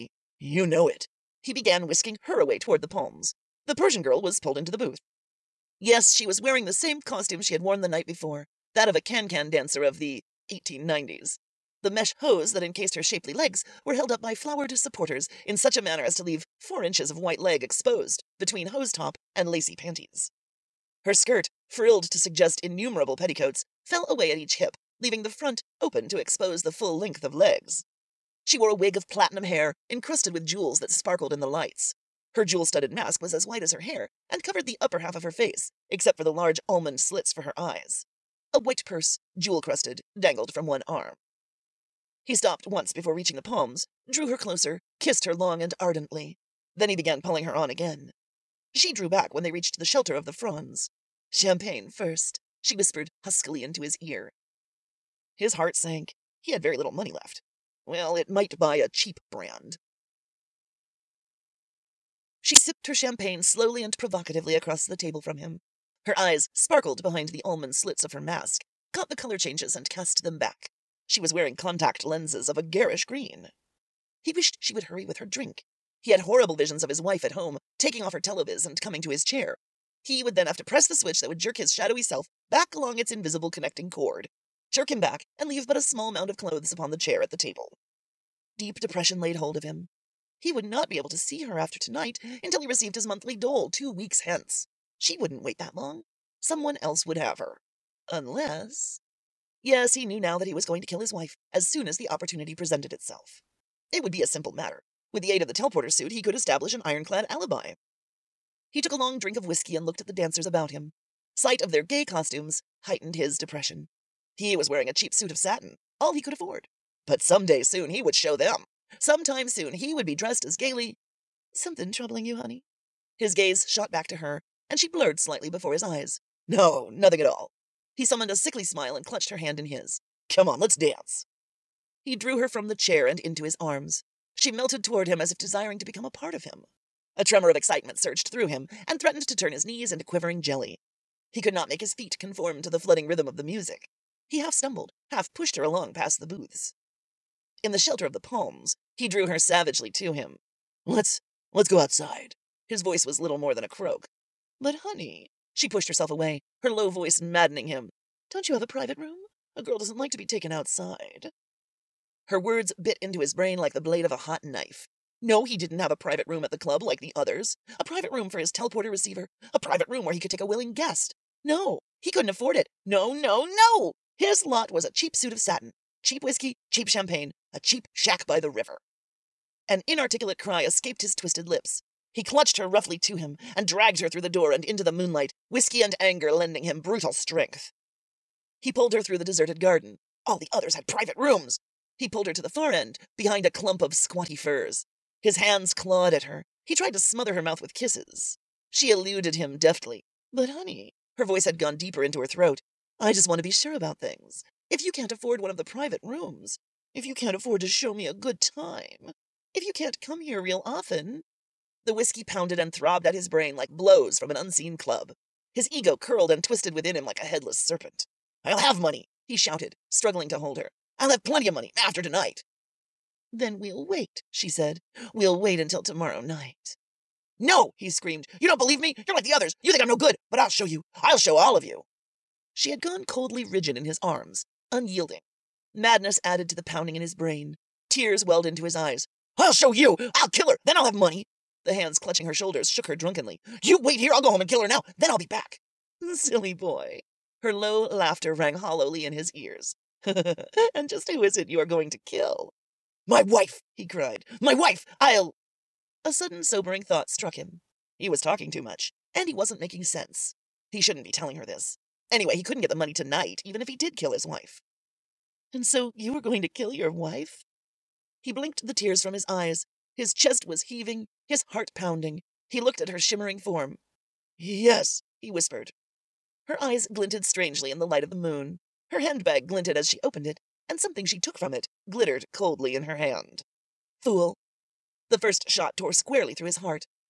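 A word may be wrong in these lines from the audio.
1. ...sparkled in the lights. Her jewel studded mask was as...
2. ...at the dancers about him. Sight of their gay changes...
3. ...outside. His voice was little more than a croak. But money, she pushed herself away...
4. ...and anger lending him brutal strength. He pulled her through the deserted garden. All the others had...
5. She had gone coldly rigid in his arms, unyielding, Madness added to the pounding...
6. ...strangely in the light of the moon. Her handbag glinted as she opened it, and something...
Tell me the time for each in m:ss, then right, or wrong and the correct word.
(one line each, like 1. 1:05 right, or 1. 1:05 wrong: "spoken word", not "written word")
1. 0:30 right
2. 1:50 wrong: "costumes", not "changes"
3. 2:31 wrong: "honey", not "money"
4. 3:05 right
5. 3:52 right
6. 4:37 right.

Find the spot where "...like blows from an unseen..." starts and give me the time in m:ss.
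3:33.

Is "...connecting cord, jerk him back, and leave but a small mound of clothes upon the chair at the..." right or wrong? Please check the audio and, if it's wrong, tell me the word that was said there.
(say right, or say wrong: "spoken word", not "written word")
right.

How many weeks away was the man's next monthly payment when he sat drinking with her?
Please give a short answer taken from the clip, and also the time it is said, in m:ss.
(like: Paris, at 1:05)
2, at 1:33.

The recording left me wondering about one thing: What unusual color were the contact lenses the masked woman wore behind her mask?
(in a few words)
Green.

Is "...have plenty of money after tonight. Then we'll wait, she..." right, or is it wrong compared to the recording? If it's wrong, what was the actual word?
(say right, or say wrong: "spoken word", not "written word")
right.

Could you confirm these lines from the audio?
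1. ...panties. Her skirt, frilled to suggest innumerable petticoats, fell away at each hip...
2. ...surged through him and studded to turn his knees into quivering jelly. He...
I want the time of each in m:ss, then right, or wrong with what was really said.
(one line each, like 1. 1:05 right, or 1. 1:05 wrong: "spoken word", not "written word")
1. 0:19 right
2. 2:17 wrong: "threatened", not "studded".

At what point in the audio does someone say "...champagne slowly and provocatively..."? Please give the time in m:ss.
1:02.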